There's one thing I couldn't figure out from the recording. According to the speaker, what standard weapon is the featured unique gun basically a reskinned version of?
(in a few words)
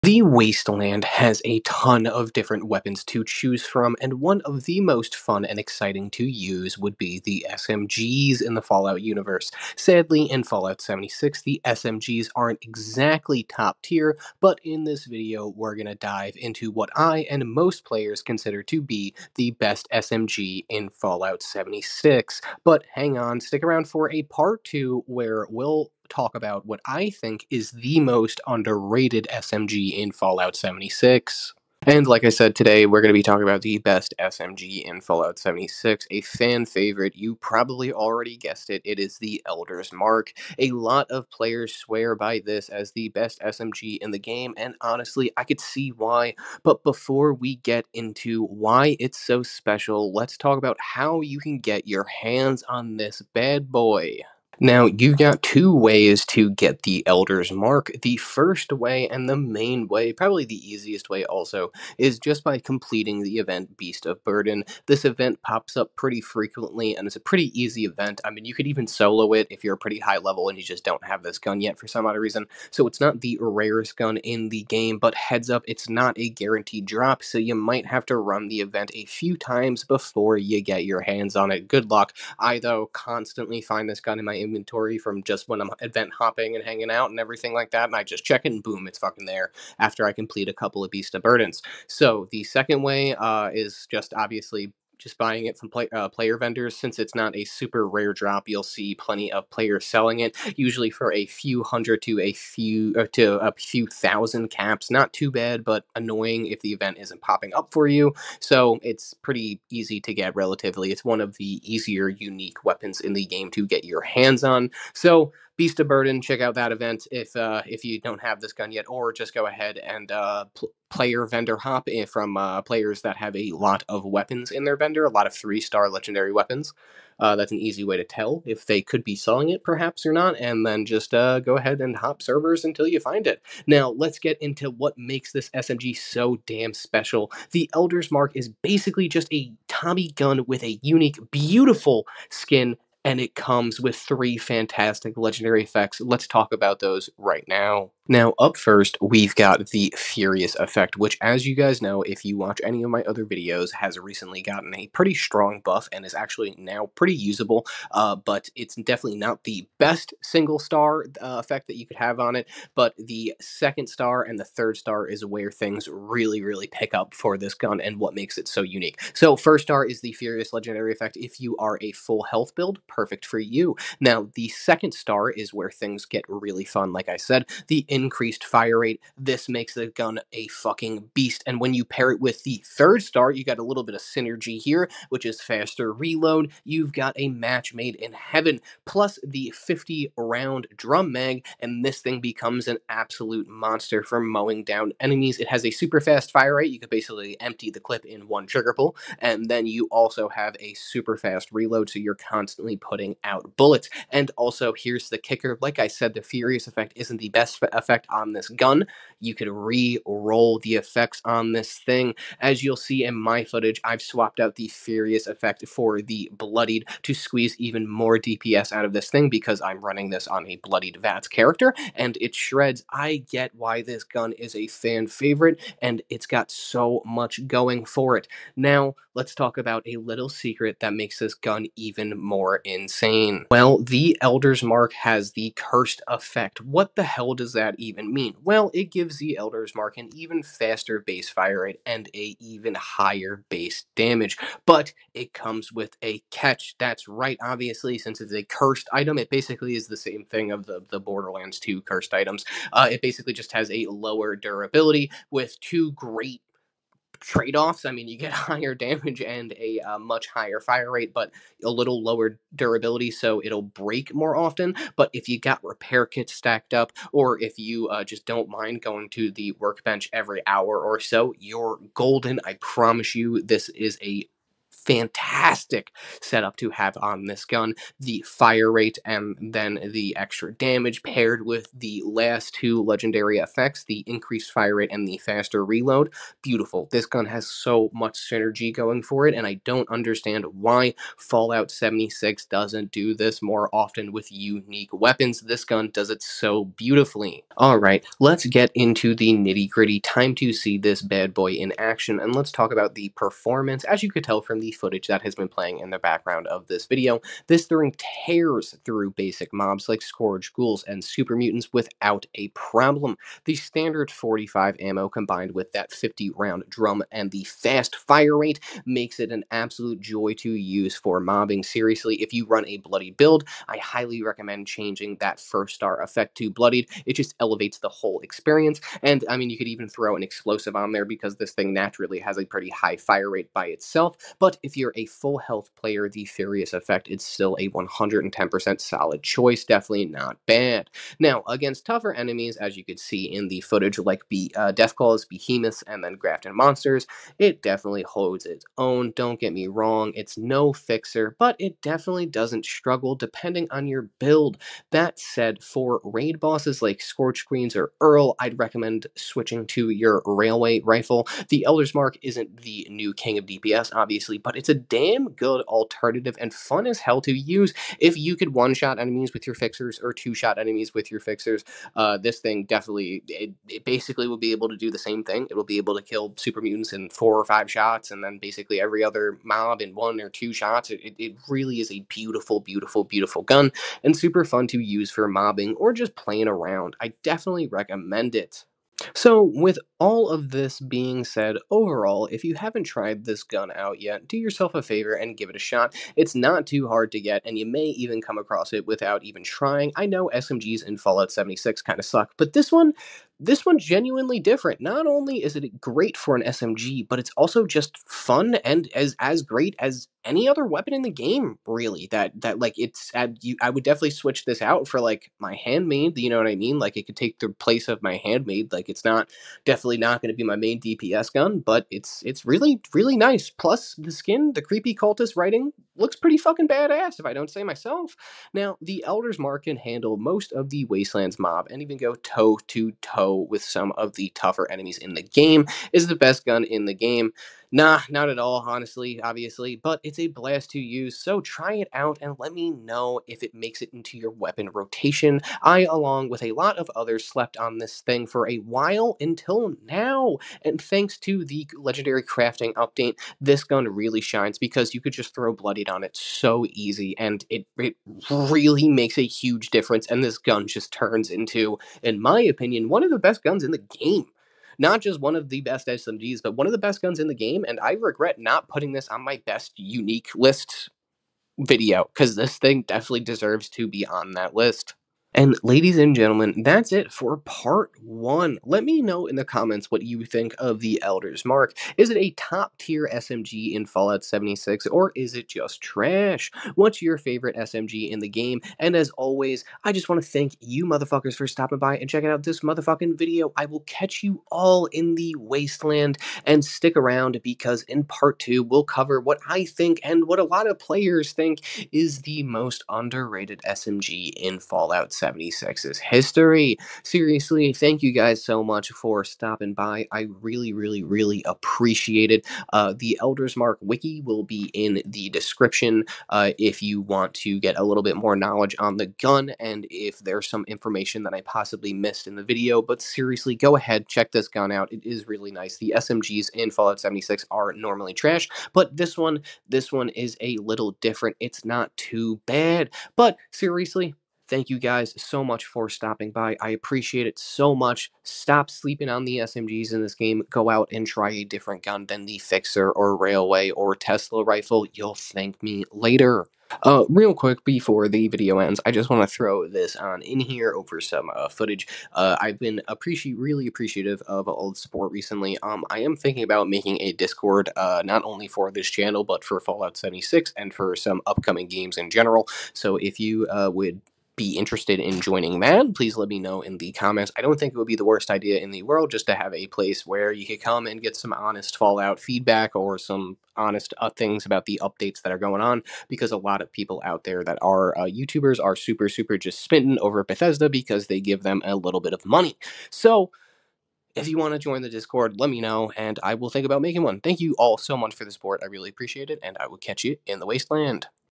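Tommy gun.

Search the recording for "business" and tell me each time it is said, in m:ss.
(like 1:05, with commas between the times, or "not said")
not said.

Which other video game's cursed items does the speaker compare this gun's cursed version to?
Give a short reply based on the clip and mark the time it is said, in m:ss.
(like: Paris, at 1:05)
Borderlands 2, at 4:10.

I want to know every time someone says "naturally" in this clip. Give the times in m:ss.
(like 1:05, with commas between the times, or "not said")
5:31.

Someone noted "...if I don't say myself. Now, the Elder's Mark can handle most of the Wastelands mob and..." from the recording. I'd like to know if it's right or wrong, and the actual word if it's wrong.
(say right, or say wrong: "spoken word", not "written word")
right.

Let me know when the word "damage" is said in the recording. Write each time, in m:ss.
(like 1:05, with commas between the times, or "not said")
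4:03, 4:18, 4:40.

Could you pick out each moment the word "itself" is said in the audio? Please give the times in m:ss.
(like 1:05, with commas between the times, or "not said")
5:33.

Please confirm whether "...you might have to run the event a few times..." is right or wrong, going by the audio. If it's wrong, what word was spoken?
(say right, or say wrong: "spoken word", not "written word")
right.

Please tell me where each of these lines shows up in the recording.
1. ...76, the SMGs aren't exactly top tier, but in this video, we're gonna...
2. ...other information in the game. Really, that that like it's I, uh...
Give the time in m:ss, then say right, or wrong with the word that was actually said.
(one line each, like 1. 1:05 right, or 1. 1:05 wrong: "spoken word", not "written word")
1. 0:10 right
2. 6:50 wrong: "weapon", not "information".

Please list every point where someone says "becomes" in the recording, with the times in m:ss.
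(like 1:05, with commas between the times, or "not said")
3:12.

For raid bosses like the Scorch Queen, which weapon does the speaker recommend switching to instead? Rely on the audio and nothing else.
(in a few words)
Railway Rifle.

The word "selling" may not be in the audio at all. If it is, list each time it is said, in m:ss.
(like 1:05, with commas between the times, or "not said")
1:39, 2:09.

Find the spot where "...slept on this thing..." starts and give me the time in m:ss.
7:27.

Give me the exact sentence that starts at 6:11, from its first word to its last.
Uh, this thing definitely, it, it, basically will be able to do the same thing.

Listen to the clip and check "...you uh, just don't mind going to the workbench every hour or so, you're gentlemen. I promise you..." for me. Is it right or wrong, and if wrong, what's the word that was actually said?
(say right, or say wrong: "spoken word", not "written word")
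wrong: "golden", not "gentlemen".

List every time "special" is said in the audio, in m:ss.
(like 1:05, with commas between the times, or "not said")
0:49, 2:16.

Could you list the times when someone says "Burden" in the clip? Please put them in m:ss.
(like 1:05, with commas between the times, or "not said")
1:04, 1:31, 1:55.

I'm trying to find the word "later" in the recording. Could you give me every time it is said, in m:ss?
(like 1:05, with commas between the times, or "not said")
9:05.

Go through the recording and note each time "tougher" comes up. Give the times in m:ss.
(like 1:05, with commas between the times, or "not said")
5:41, 7:14.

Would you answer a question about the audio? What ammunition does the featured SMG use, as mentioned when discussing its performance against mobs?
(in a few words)
45.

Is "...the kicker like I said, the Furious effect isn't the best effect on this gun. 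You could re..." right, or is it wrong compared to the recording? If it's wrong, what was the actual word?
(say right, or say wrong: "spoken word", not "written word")
right.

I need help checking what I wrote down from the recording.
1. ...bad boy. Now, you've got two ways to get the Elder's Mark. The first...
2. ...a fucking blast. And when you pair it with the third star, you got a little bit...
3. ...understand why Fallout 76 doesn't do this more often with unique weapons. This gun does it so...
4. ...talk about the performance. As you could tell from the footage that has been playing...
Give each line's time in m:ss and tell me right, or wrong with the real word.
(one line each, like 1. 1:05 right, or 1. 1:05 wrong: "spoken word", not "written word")
1. 0:53 right
2. 3:00 wrong: "beast", not "blast"
3. 4:49 right
4. 5:02 right.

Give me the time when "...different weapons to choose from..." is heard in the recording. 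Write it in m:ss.
0:02.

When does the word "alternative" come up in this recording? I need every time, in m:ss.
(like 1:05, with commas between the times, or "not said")
6:05.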